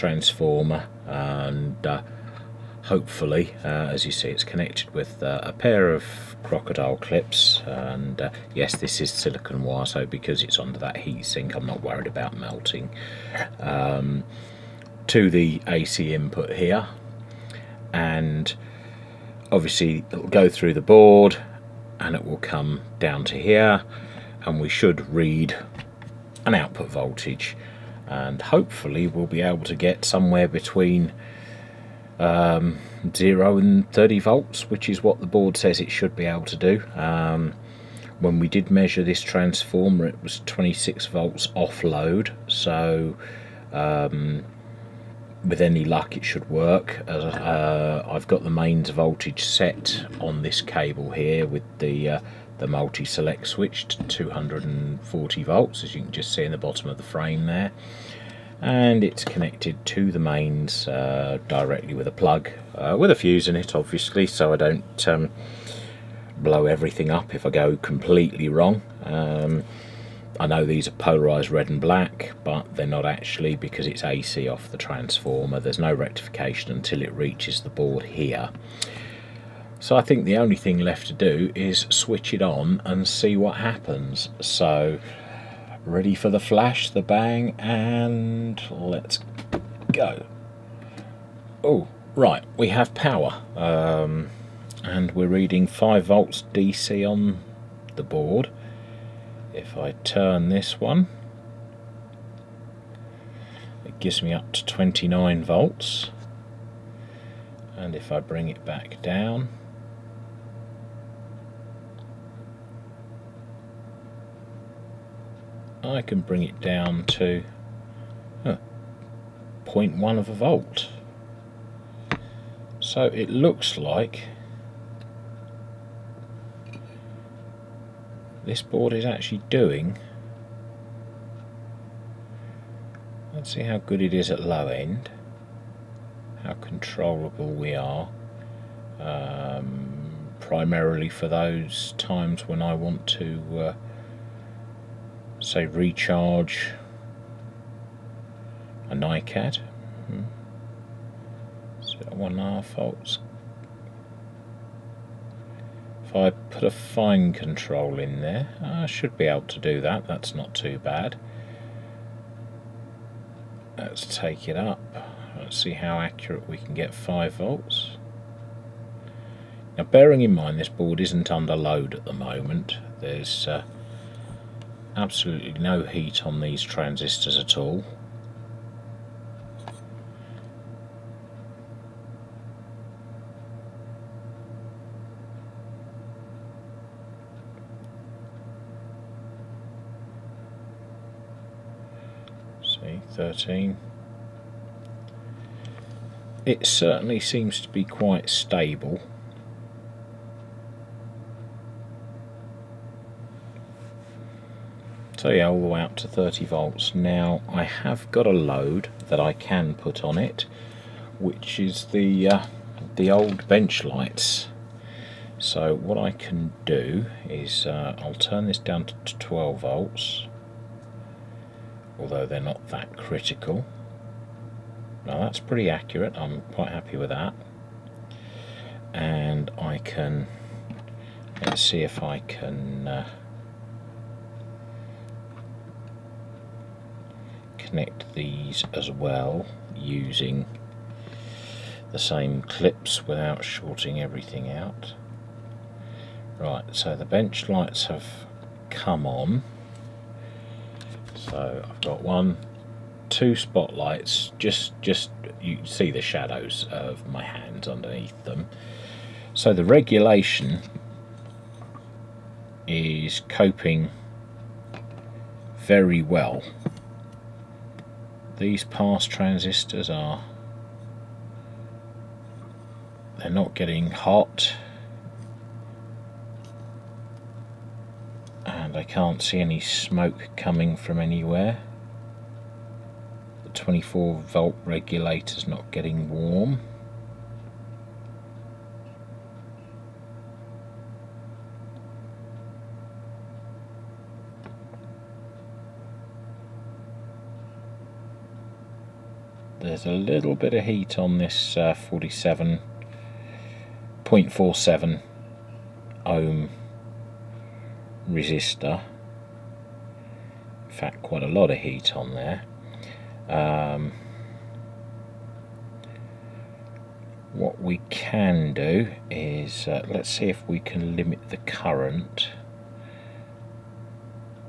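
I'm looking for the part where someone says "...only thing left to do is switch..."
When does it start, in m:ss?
1:20.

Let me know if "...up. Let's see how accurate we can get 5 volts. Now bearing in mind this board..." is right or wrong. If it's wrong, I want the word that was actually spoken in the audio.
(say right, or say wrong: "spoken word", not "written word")
right.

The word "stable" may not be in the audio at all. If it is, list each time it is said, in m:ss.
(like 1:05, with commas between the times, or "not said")
3:18.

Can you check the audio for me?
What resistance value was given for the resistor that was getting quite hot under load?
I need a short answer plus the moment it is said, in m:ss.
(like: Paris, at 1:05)
47.47 ohms, at 5:01.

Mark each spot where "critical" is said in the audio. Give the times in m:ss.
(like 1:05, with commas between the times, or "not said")
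3:42.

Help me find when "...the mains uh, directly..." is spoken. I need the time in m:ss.
1:00.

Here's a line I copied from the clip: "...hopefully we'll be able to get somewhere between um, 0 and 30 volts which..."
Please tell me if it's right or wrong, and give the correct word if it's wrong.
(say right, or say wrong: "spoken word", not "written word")
right.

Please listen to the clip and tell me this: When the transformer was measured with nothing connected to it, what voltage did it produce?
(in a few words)
26 volts.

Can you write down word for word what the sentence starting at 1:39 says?
If I turn this one, it gives me up to 29 volts.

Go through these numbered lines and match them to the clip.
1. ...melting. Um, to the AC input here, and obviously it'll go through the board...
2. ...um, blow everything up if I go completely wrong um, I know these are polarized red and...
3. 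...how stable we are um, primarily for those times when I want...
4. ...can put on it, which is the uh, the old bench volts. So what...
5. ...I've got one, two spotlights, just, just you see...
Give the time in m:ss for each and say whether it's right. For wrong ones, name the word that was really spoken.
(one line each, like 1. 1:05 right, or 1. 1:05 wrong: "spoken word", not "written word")
1. 0:12 right
2. 1:05 right
3. 2:16 wrong: "controllable", not "stable"
4. 3:29 wrong: "lights", not "volts"
5. 4:11 right.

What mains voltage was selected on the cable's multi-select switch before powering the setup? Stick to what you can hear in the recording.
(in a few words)
240 volts.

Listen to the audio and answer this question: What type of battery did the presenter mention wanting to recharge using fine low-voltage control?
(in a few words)
NiCad.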